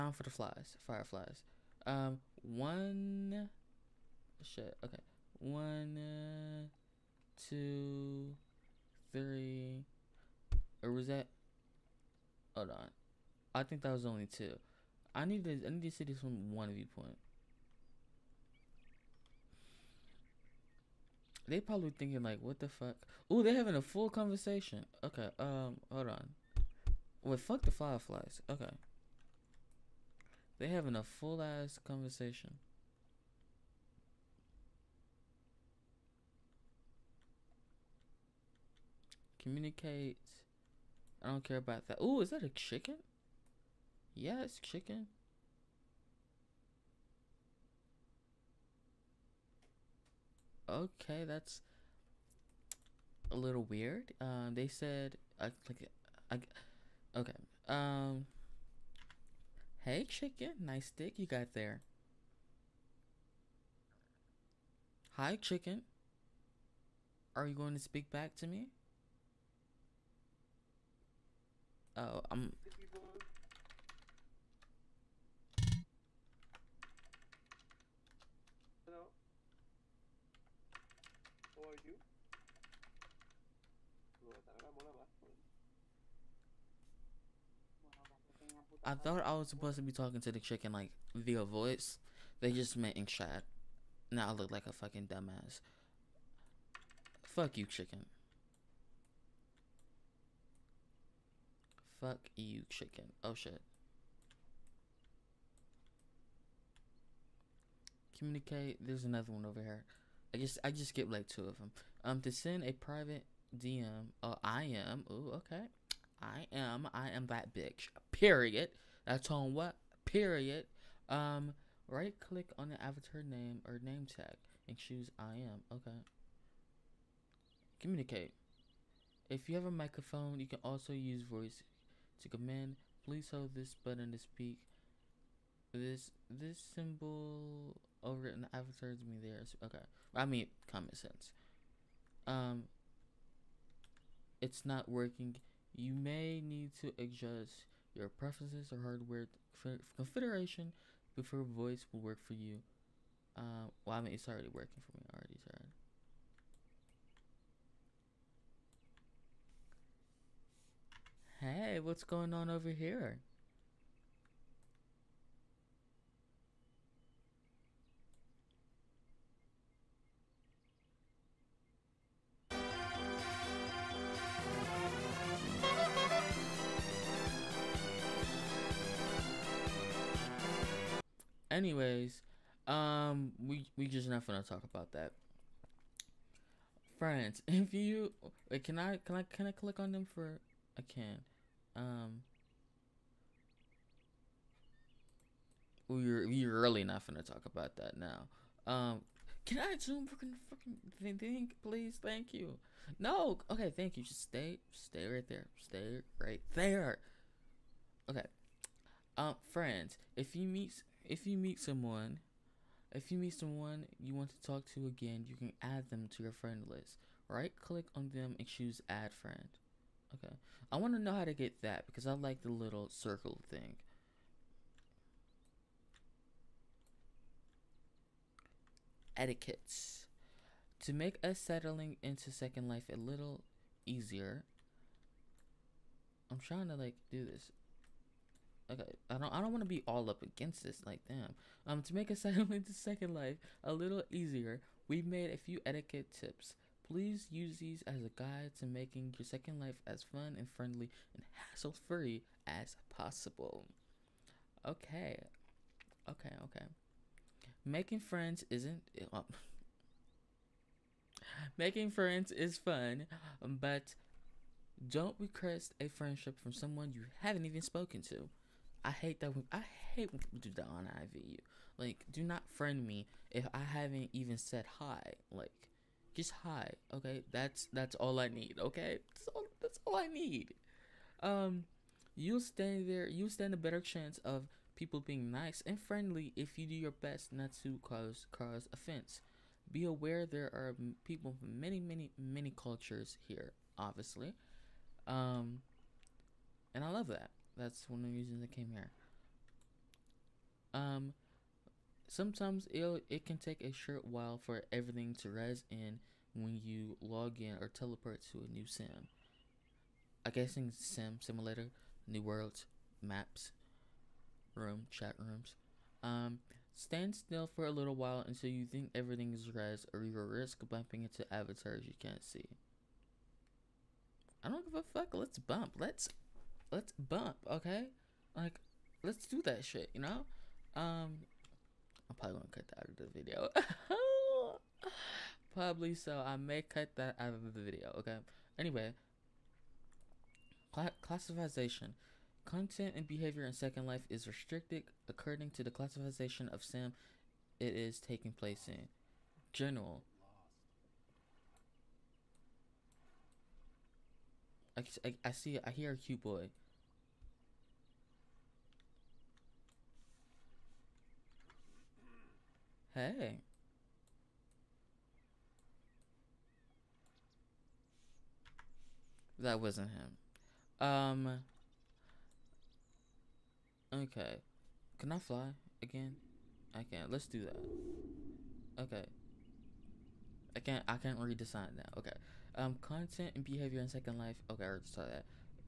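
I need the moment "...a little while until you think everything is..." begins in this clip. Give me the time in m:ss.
5:17.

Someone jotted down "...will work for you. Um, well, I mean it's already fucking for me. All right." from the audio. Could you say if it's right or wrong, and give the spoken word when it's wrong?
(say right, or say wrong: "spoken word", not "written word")
wrong: "working", not "fucking".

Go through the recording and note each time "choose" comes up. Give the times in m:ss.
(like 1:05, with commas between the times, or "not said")
2:04, 3:38.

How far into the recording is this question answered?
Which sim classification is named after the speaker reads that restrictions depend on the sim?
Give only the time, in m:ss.
5:49.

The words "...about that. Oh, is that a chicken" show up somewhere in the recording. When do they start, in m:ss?
0:41.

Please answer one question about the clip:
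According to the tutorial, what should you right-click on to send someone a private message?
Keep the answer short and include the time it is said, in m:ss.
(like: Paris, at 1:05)
avatar name or name tag, at 2:02.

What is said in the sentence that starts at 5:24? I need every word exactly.
I don't give a fuck, let's bump.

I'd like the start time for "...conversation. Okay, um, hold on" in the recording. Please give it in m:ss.
0:24.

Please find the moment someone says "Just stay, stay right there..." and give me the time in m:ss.
3:24.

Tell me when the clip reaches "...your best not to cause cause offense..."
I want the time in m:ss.
4:46.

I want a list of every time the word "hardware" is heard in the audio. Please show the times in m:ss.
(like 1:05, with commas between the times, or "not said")
2:28.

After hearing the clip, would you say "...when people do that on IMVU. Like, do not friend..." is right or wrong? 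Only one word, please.
right.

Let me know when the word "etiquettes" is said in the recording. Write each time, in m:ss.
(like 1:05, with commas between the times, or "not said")
3:49, 4:05.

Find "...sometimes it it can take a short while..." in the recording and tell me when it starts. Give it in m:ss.
5:02.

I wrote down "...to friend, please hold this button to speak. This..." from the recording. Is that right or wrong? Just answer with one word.
wrong.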